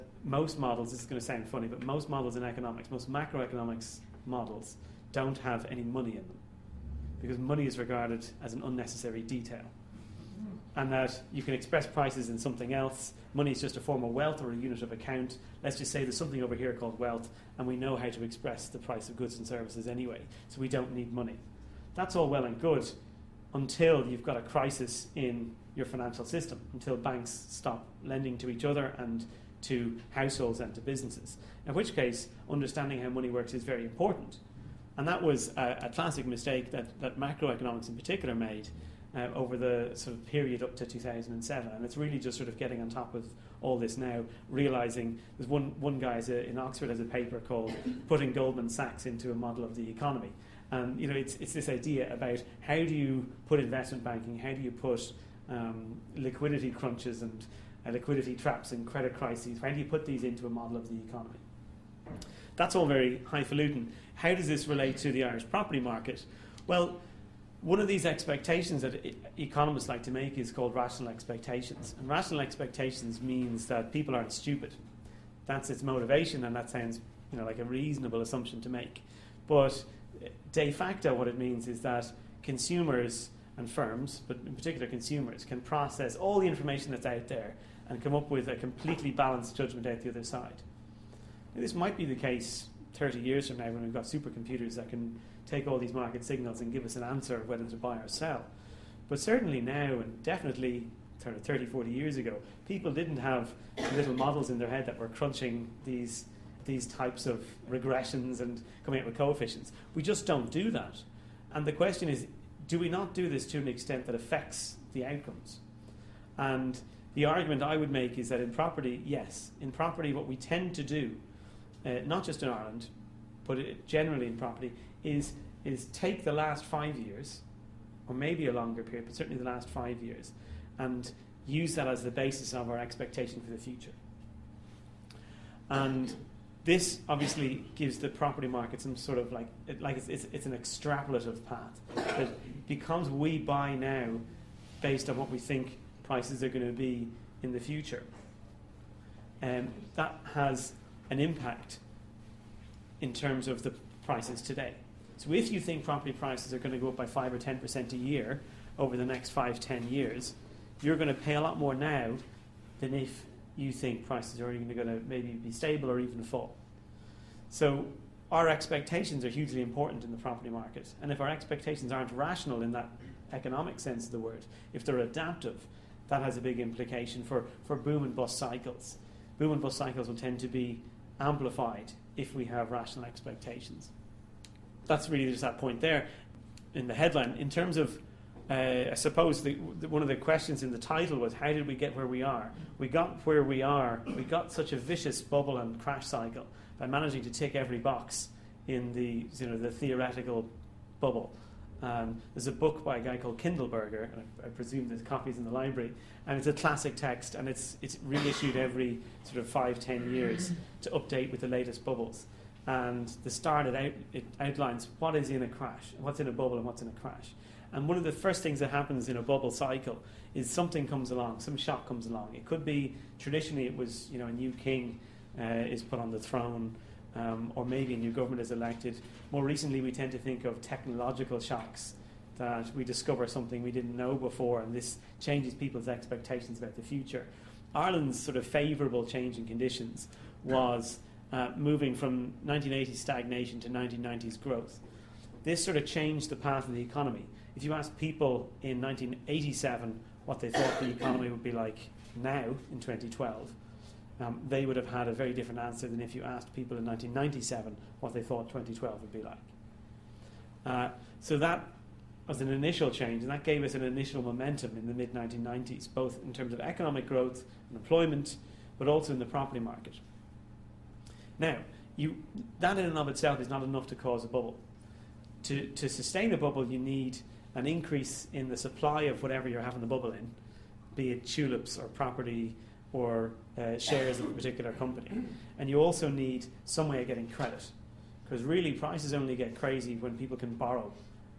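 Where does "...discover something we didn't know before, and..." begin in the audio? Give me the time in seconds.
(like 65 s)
232 s.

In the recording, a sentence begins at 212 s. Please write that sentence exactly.
And the start, it, out, it outlines what is in a crash, what's in a bubble, and what's in a crash.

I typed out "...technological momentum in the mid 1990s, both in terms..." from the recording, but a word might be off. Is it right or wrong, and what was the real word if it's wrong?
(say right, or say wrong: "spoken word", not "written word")
wrong: "initial", not "technological".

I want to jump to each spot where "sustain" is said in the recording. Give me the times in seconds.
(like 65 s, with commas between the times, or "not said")
275 s.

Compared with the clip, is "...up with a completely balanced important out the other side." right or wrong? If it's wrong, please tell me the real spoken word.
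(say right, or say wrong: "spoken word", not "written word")
wrong: "judgment", not "important".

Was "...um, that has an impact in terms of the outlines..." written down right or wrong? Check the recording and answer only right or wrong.
wrong.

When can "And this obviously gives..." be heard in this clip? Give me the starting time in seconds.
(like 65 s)
135 s.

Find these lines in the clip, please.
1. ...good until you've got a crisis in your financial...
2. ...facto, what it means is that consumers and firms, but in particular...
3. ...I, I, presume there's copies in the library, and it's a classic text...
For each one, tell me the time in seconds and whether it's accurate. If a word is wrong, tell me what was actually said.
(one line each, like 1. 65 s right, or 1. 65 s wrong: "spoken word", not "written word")
1. 22 s right
2. 80 s right
3. 204 s right.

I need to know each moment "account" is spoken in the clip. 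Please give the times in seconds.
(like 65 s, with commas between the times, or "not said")
14 s.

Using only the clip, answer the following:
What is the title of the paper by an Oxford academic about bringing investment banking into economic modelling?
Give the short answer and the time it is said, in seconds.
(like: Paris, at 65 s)
Putting Goldman Sachs into a Model of the Economy, at 48 s.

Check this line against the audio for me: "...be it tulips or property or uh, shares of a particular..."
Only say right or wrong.
right.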